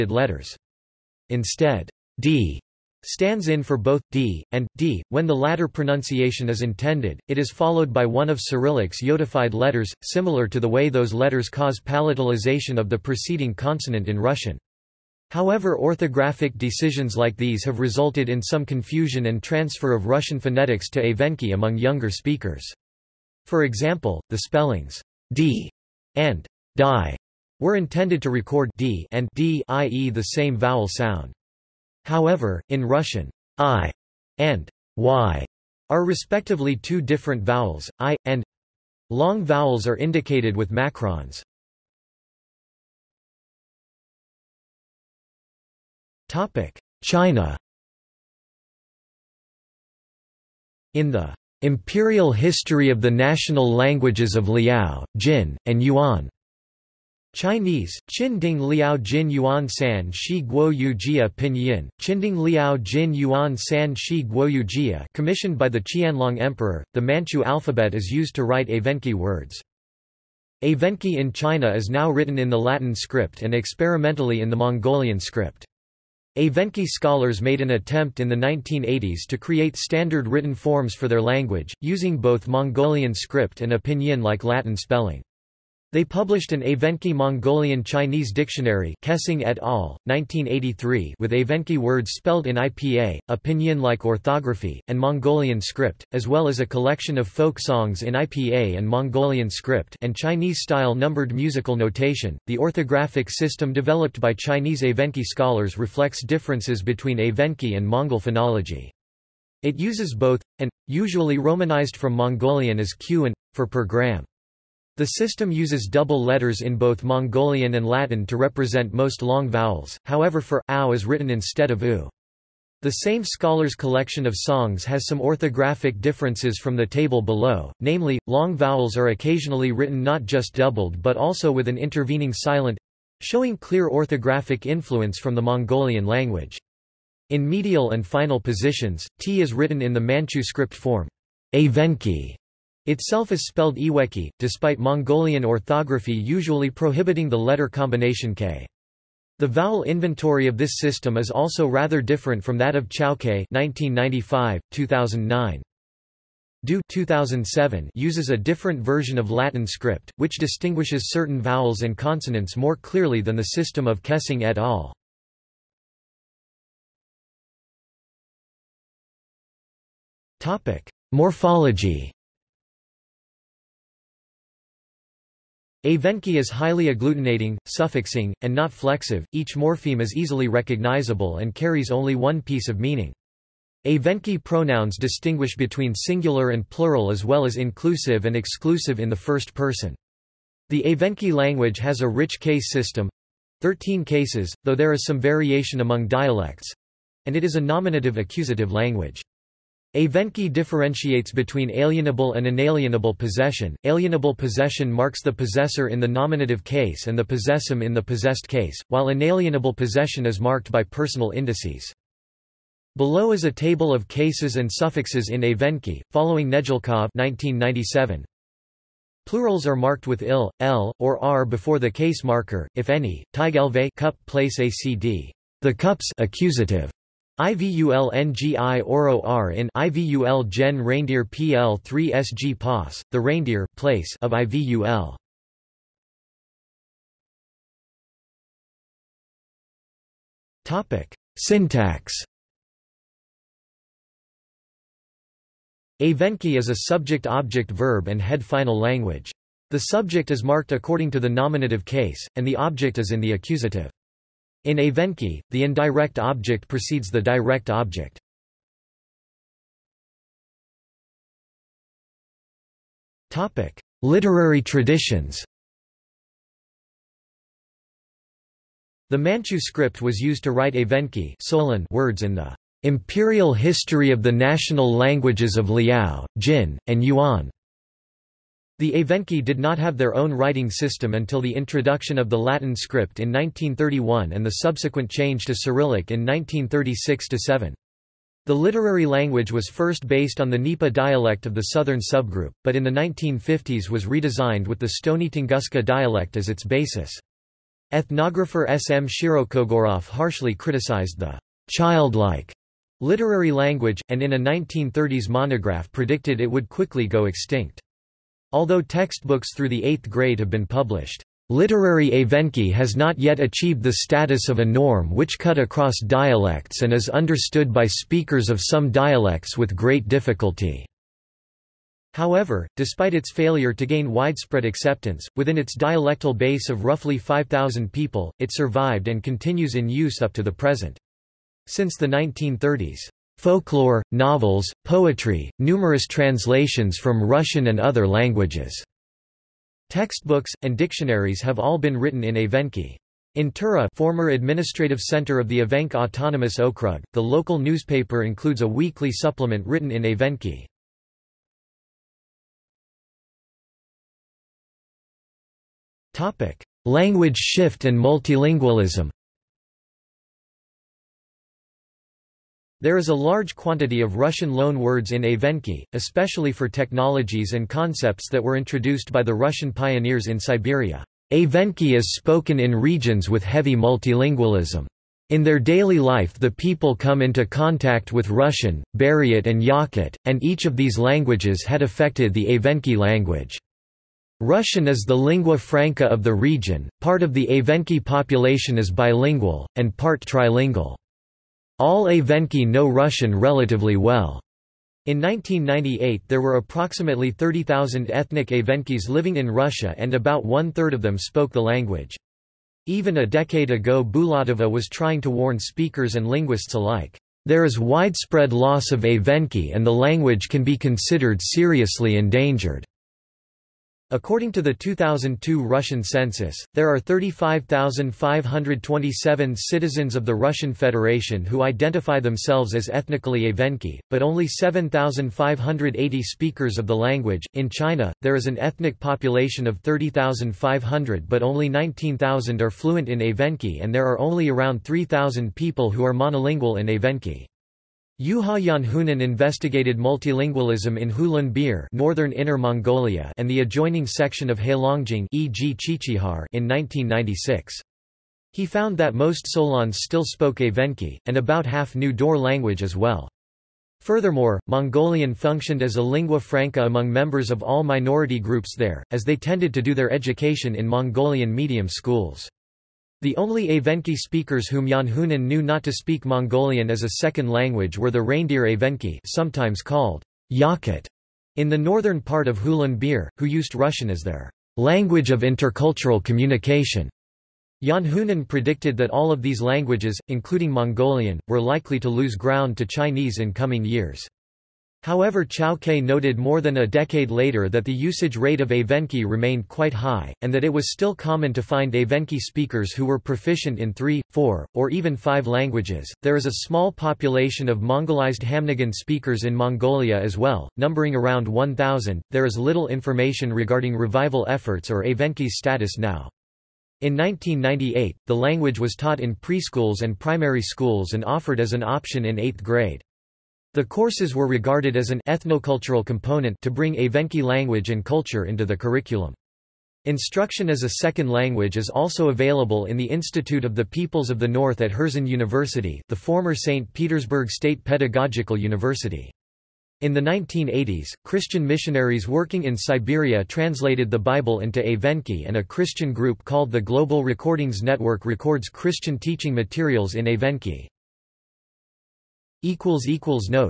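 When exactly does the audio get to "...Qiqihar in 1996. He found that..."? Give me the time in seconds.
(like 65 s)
445 s.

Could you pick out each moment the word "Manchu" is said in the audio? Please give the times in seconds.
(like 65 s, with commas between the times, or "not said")
67 s, 139 s, 269 s.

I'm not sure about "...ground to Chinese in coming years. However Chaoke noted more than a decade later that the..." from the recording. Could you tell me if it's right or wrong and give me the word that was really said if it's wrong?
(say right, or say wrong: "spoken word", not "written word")
right.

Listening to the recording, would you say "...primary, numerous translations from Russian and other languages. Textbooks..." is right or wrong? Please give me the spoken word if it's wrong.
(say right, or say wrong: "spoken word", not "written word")
wrong: "poetry", not "primary".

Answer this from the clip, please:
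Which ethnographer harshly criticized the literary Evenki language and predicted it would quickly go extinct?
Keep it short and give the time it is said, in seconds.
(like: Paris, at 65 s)
S. M. Shirokogorov, at 298 s.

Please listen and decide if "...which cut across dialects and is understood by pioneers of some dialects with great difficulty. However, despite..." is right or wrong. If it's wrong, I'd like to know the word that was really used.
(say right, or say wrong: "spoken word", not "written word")
wrong: "speakers", not "pioneers".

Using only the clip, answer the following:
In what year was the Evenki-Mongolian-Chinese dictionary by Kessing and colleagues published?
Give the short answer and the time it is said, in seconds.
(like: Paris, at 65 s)
1983, at 90 s.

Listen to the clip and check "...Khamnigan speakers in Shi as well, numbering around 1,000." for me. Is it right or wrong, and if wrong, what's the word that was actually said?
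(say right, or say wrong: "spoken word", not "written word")
wrong: "Mongolia", not "Shi".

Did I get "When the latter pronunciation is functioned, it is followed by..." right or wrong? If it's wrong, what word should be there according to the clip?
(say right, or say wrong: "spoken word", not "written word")
wrong: "intended", not "functioned".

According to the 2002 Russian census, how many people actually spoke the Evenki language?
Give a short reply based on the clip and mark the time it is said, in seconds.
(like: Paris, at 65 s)
7,580, at 424 s.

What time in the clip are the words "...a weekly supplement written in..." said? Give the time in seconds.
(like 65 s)
348 s.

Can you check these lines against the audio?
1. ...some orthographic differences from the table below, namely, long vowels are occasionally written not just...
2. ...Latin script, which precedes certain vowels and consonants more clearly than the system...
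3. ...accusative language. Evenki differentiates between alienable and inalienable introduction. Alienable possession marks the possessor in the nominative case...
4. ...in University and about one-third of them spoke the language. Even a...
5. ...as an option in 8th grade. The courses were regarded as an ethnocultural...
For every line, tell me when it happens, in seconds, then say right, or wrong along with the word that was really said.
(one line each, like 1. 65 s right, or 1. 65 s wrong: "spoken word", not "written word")
1. 125 s right
2. 159 s wrong: "distinguishes", not "precedes"
3. 198 s wrong: "possession", not "introduction"
4. 399 s wrong: "Russia", not "University"
5. 511 s right.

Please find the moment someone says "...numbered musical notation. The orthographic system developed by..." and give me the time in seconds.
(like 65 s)
100 s.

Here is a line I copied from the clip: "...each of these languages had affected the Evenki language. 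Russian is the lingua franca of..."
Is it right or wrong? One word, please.
right.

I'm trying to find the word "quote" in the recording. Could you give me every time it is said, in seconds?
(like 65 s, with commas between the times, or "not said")
not said.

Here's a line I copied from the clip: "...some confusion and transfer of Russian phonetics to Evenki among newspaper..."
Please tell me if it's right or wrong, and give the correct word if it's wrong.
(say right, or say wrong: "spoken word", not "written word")
wrong: "younger", not "newspaper".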